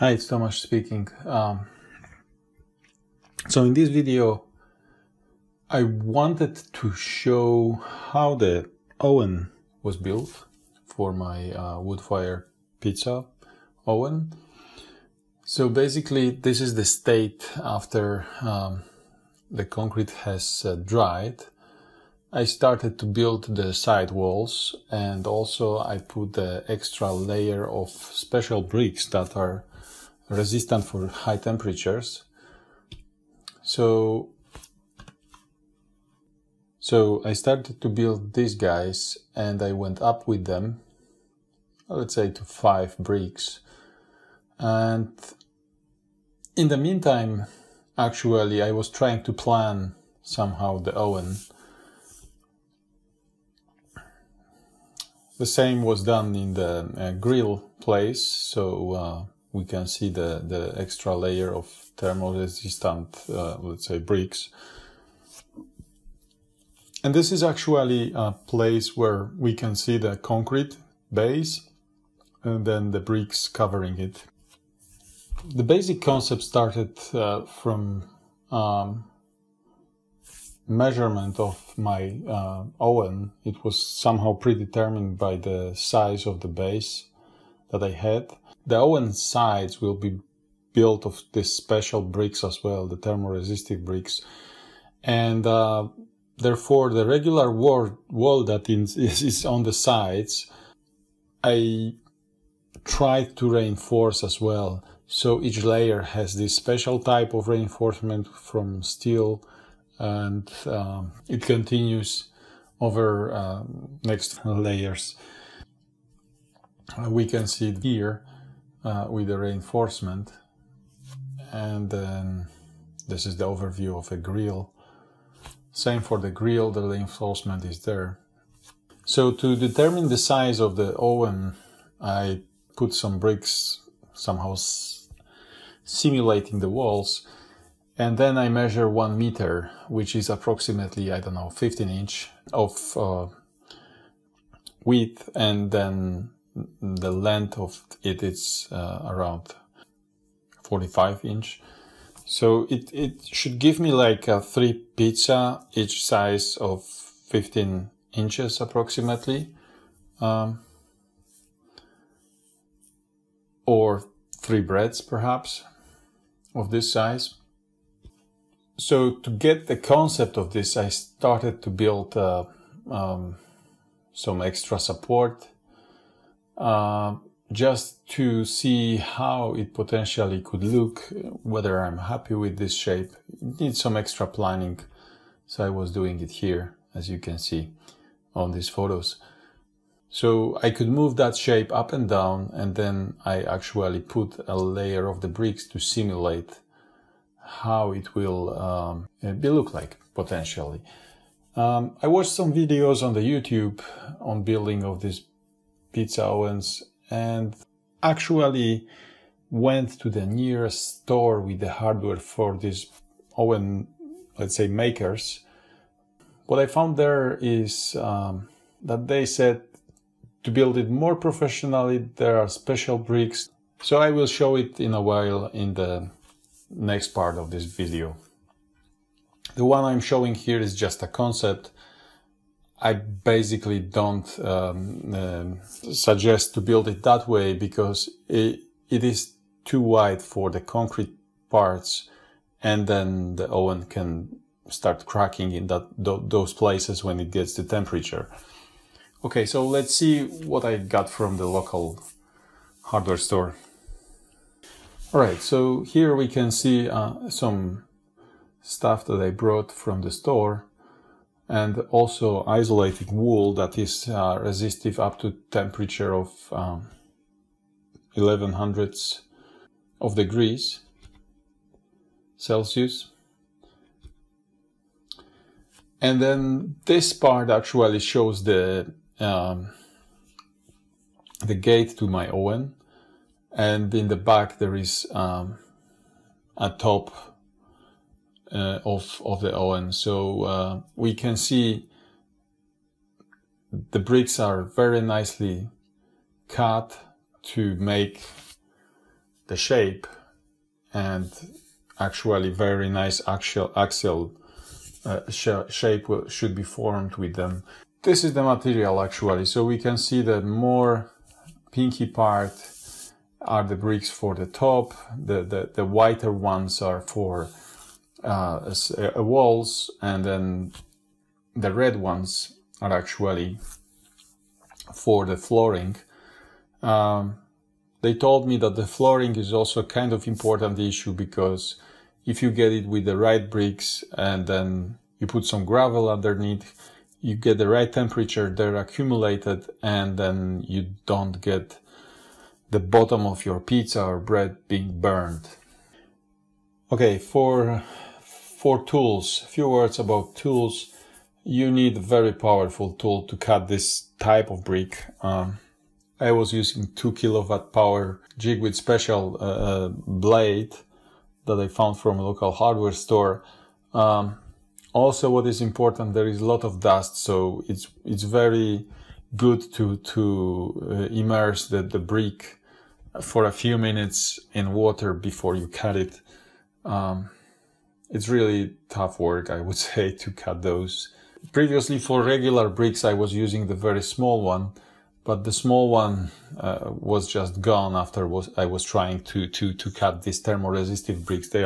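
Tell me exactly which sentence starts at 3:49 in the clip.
The one I'm showing here is just a concept.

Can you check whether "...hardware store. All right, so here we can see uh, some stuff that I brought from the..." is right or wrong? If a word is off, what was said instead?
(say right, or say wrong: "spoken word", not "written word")
right.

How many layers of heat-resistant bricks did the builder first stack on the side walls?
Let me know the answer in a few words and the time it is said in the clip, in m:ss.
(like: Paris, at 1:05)
5 bricks, at 0:42.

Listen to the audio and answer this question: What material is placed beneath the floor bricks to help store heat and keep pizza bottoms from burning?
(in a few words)
Gravel.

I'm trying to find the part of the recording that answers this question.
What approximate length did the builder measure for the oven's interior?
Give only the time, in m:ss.
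2:30.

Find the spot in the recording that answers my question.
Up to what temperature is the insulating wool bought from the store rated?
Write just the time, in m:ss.
4:28.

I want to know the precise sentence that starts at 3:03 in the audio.
It needs some extra planning, so I was doing it here, as you can see on these photos.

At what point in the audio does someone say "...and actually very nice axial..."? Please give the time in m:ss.
5:00.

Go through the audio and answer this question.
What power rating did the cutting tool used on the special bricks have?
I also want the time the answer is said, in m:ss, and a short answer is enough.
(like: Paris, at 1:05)
2 kilowatt, at 5:56.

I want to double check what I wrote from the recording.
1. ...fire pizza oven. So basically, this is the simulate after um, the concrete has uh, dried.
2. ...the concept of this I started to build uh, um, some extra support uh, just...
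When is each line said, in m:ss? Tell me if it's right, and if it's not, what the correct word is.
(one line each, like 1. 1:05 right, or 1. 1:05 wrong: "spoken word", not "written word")
1. 0:12 wrong: "state", not "simulate"
2. 2:49 right.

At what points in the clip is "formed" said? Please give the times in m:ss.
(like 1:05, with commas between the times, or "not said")
5:06.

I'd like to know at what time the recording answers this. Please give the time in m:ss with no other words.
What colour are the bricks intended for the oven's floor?
5:21.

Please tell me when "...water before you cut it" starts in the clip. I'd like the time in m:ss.
6:14.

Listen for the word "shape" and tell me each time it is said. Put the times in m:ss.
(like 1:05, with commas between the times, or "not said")
3:02, 3:11, 4:59, 5:05.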